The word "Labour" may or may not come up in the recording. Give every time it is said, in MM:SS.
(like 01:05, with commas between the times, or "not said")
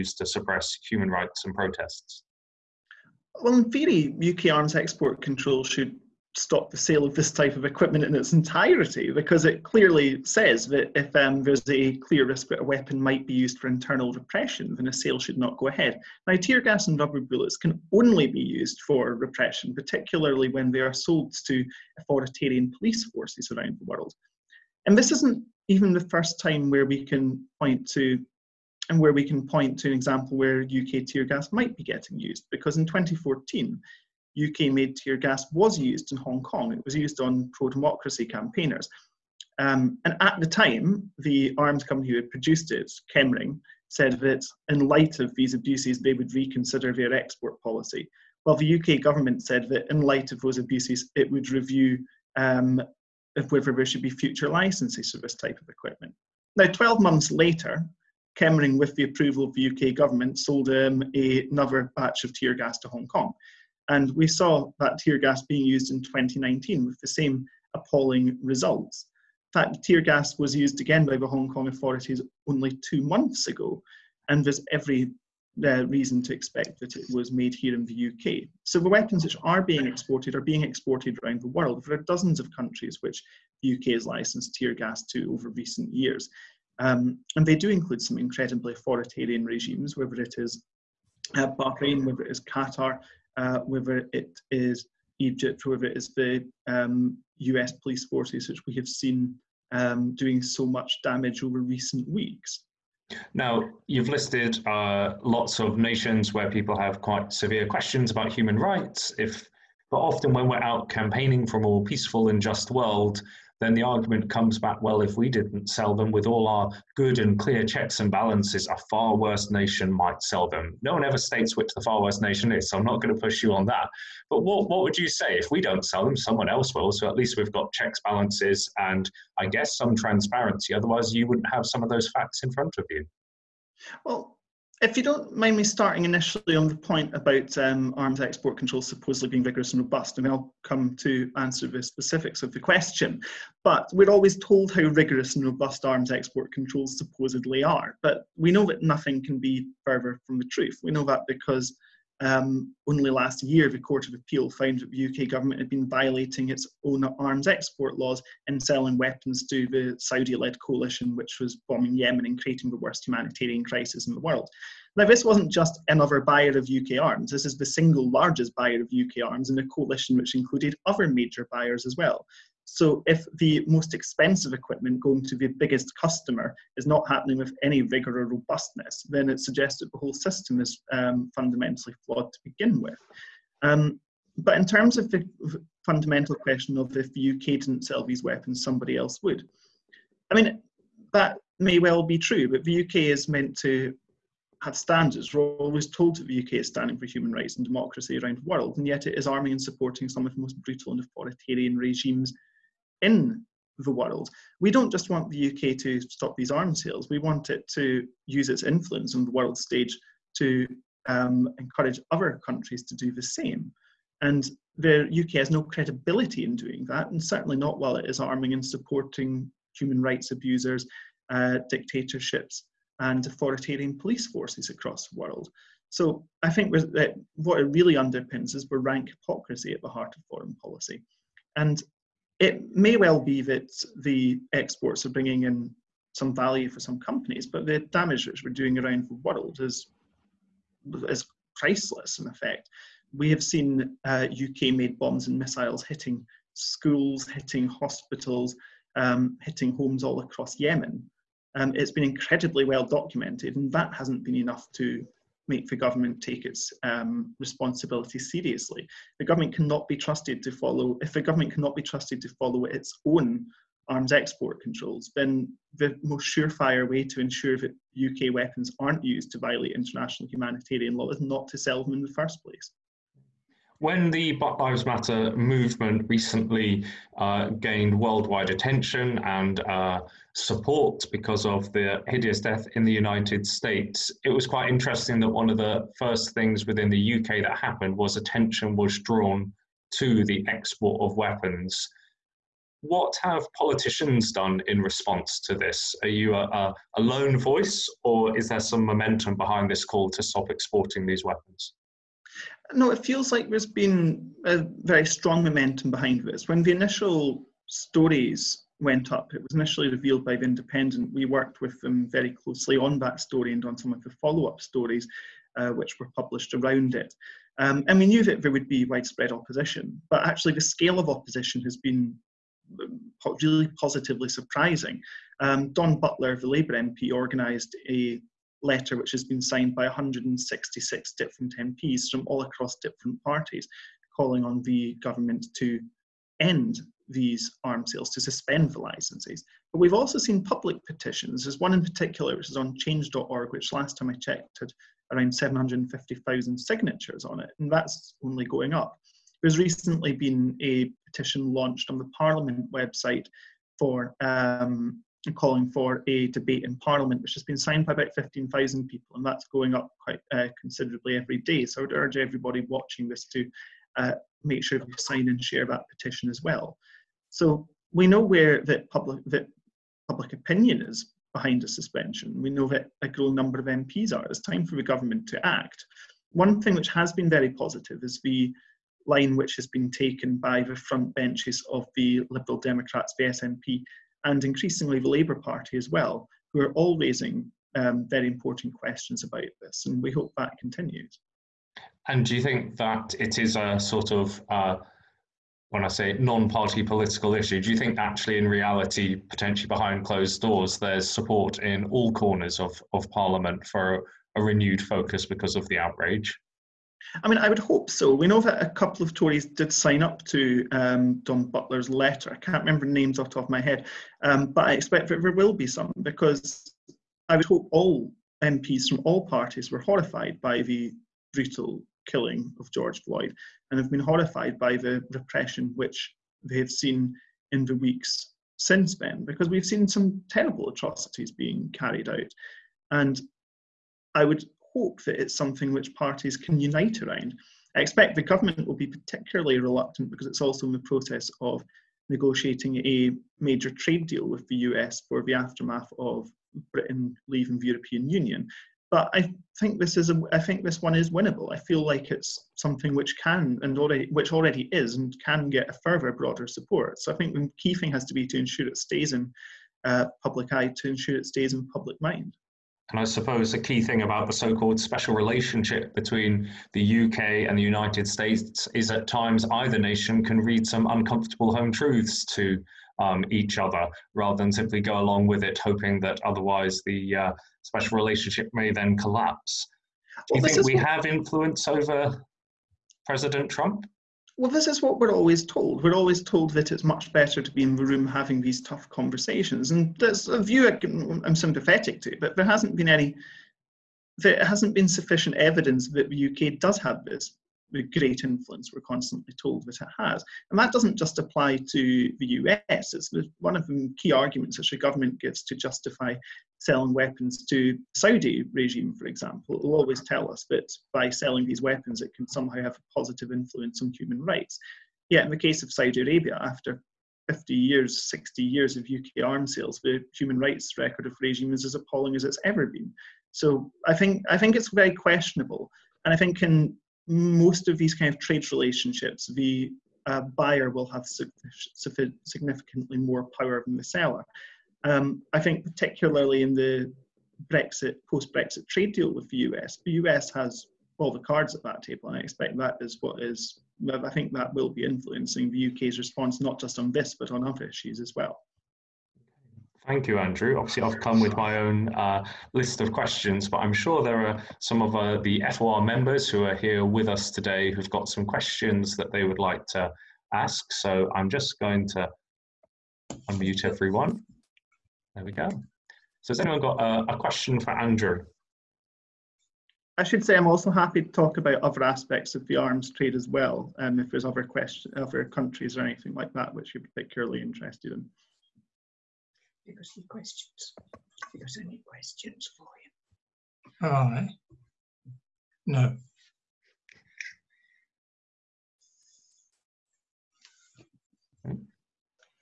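05:26, 06:25.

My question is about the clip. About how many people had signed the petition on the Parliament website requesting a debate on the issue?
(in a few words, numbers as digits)
15,000.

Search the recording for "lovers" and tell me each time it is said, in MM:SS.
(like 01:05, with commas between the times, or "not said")
not said.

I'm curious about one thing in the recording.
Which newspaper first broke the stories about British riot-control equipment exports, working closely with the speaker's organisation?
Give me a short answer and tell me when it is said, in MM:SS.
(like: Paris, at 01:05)
The Independent, at 05:10.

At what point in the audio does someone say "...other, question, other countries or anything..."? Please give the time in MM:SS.
09:34.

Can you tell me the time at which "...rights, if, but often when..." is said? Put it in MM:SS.
01:48.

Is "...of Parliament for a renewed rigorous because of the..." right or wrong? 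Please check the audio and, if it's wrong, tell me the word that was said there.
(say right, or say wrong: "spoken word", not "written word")
wrong: "focus", not "rigorous".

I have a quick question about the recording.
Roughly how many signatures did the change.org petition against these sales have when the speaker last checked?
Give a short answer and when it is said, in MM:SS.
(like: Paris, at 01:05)
750,000, at 05:45.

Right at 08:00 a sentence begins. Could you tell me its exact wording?
Do well, you think we have influence over President Trump?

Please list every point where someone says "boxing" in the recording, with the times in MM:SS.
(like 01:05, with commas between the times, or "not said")
not said.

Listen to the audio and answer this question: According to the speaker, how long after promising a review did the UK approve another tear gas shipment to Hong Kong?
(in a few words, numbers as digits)
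12 months.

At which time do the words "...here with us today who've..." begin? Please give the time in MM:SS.
09:16.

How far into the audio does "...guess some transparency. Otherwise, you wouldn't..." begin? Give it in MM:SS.
02:09.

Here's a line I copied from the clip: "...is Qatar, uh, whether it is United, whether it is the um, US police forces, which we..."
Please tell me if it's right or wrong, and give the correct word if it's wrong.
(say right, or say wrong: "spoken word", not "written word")
wrong: "Egypt", not "United".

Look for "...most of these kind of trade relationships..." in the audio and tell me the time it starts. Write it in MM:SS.
08:47.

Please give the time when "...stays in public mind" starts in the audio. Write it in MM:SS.
07:41.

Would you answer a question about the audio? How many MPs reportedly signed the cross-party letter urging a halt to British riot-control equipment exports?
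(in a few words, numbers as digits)
166.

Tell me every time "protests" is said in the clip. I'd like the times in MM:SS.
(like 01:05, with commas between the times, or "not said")
00:01.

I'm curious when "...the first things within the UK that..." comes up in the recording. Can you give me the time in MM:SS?
04:45.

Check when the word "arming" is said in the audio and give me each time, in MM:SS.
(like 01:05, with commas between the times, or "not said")
03:19, 03:38.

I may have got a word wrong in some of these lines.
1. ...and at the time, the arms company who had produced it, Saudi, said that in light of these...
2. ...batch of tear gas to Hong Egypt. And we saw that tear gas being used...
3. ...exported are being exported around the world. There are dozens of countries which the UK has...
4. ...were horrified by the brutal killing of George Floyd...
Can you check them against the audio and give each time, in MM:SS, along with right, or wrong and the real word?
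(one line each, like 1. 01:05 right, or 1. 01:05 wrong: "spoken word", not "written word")
1. 00:40 wrong: "Chemring", not "Saudi"
2. 01:01 wrong: "Kong", not "Egypt"
3. 01:19 right
4. 06:59 right.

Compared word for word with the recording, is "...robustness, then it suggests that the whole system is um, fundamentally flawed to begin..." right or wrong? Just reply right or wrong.
right.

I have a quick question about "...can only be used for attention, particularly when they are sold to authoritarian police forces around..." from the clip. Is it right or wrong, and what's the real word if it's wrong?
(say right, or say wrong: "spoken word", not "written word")
wrong: "repression", not "attention".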